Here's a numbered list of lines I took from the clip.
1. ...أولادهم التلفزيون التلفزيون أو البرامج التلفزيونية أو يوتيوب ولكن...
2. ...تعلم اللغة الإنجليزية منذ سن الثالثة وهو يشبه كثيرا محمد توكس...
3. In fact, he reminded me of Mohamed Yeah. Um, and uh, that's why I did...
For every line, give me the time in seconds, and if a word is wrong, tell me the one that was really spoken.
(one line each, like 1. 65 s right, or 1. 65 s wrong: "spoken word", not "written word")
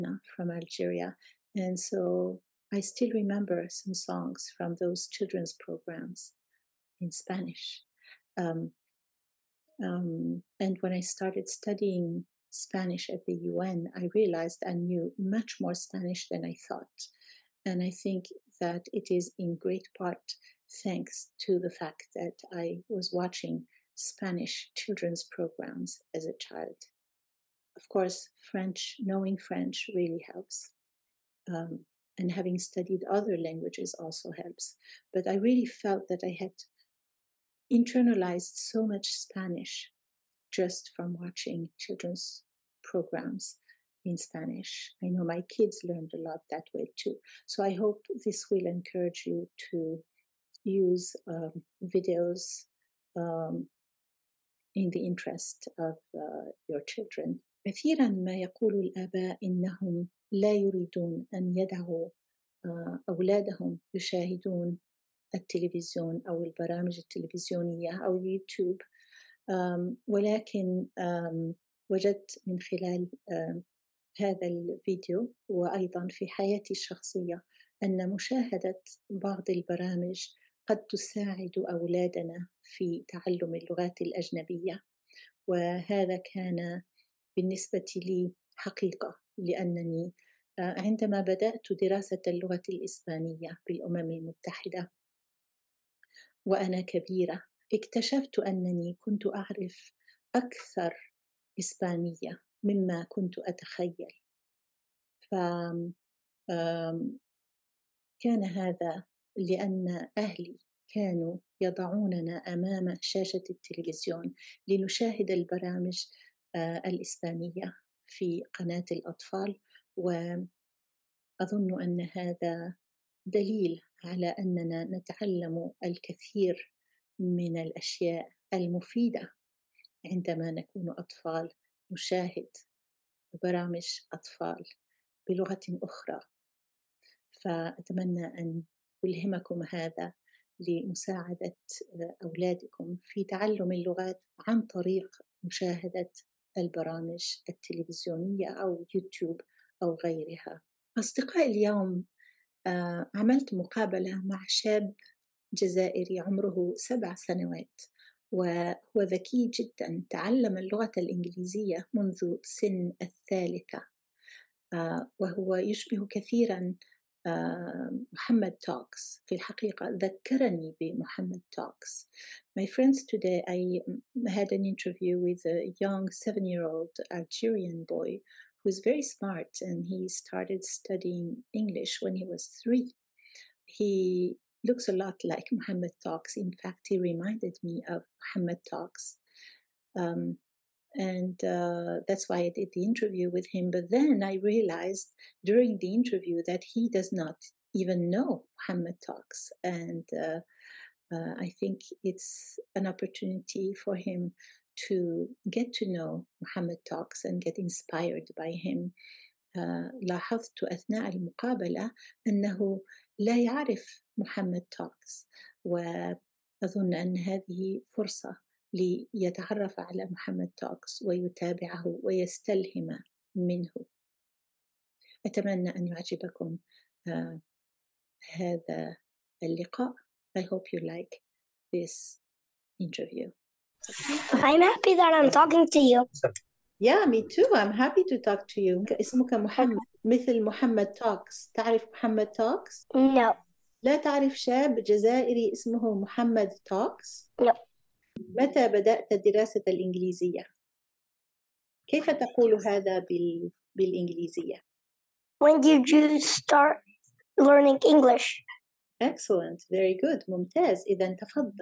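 1. 63 s wrong: "يشاهدون", not "التلفزيون"
2. 160 s right
3. 186 s wrong: "Talks", not "Yeah".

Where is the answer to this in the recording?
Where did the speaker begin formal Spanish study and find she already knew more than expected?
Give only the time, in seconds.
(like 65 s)
13 s.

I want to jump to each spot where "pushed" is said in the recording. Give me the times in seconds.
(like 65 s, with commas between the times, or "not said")
not said.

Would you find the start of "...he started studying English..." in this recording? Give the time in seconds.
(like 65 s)
179 s.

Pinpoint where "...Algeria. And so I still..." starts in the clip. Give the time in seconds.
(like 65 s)
0 s.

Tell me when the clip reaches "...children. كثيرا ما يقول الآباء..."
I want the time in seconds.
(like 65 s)
56 s.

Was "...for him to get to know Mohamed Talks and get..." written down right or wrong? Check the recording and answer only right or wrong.
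right.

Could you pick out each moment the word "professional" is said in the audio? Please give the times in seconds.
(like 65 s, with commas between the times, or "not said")
not said.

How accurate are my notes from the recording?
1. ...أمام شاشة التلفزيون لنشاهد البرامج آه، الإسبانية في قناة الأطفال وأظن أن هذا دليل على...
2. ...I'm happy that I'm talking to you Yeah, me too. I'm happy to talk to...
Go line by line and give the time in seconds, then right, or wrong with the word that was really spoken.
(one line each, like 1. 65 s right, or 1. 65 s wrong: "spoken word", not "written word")
1. 112 s right
2. 234 s right.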